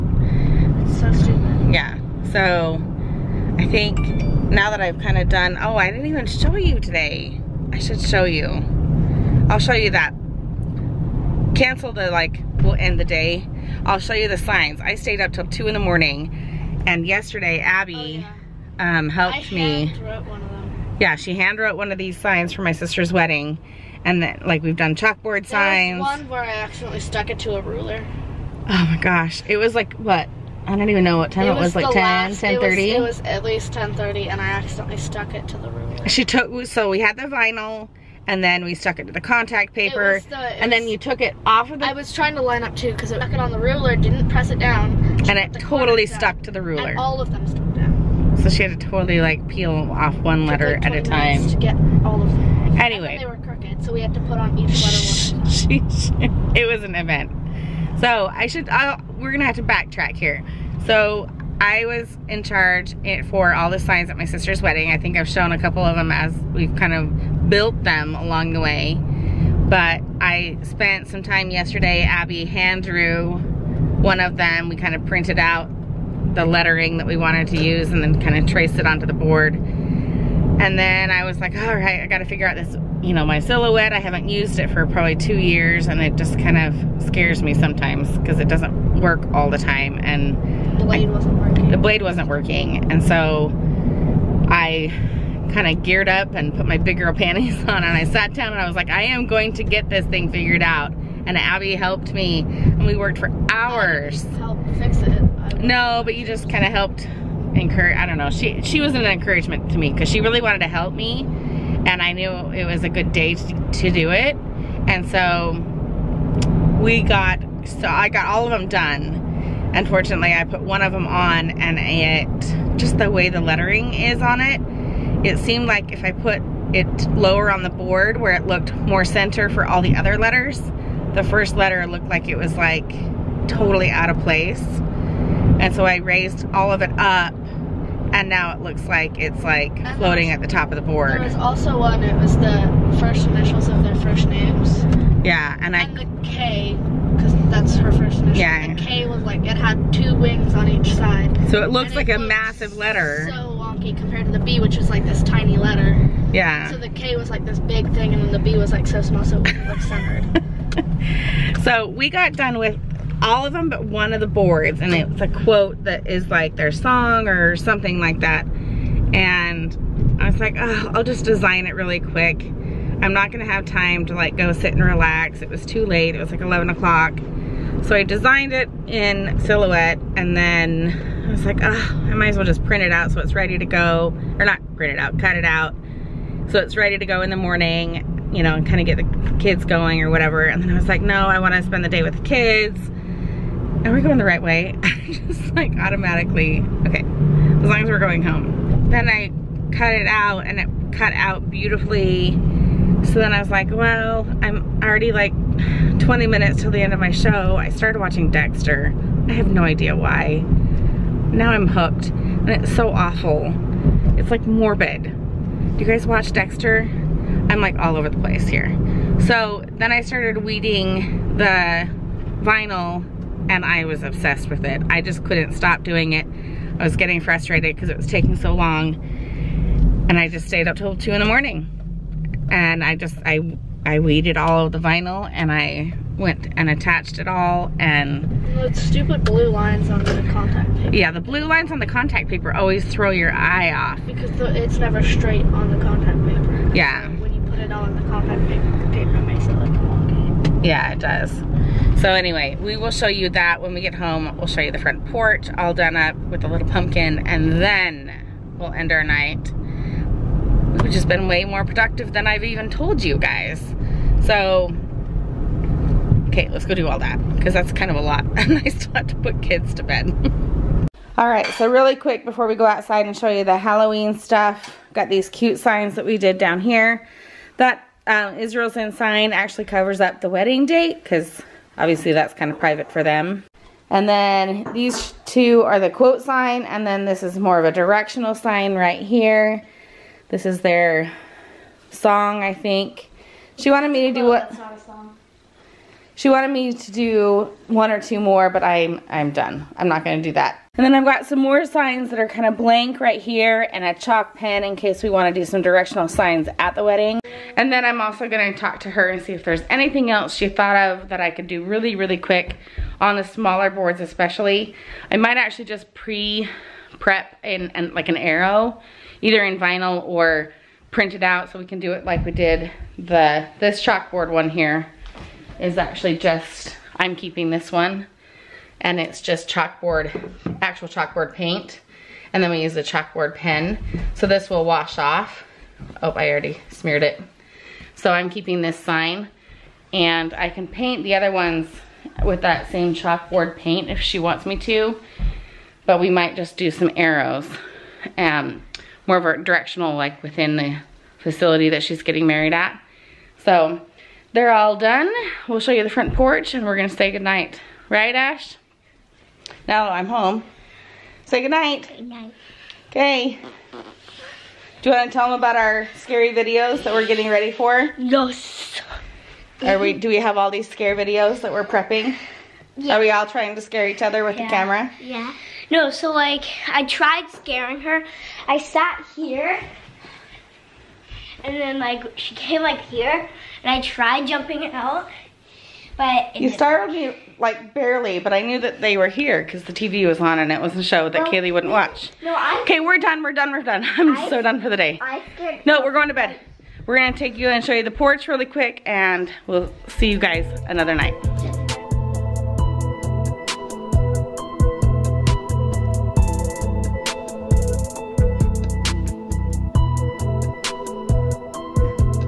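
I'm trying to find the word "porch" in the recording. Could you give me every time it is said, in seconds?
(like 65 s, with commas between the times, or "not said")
255 s, 356 s, 397 s.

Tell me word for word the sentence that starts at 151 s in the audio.
So it looks and like it a massive letter.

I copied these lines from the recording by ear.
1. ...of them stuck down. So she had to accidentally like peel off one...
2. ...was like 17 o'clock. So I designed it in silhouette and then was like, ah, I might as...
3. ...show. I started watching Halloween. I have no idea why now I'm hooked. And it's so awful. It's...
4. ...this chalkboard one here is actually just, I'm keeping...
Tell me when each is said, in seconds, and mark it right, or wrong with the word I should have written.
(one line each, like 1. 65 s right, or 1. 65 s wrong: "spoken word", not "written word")
1. 47 s wrong: "totally", not "accidentally"
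2. 176 s wrong: "11", not "17"
3. 207 s wrong: "Dexter", not "Halloween"
4. 323 s right.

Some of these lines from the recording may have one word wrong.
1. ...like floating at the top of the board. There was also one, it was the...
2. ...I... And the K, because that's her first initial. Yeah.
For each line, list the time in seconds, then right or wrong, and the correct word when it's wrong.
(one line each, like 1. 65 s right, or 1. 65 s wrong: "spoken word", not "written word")
1. 139 s right
2. 145 s right.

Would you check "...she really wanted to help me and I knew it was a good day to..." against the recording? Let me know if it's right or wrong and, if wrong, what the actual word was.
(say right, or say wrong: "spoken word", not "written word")
right.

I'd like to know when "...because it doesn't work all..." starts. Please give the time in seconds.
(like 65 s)
88 s.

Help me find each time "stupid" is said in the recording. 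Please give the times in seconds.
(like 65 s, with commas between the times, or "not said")
1 s, 238 s.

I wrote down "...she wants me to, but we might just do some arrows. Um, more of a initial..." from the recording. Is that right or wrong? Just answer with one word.
wrong.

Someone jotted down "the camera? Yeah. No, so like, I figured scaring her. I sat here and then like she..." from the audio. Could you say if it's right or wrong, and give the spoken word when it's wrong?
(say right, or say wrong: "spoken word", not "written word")
wrong: "tried", not "figured".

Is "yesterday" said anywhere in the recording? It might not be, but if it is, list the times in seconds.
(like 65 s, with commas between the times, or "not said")
17 s, 71 s.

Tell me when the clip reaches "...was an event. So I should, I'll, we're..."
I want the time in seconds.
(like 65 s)
56 s.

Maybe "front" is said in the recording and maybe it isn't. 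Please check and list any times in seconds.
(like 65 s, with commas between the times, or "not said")
254 s, 355 s.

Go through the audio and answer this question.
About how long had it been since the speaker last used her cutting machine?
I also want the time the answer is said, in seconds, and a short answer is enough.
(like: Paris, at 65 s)
2 years, at 84 s.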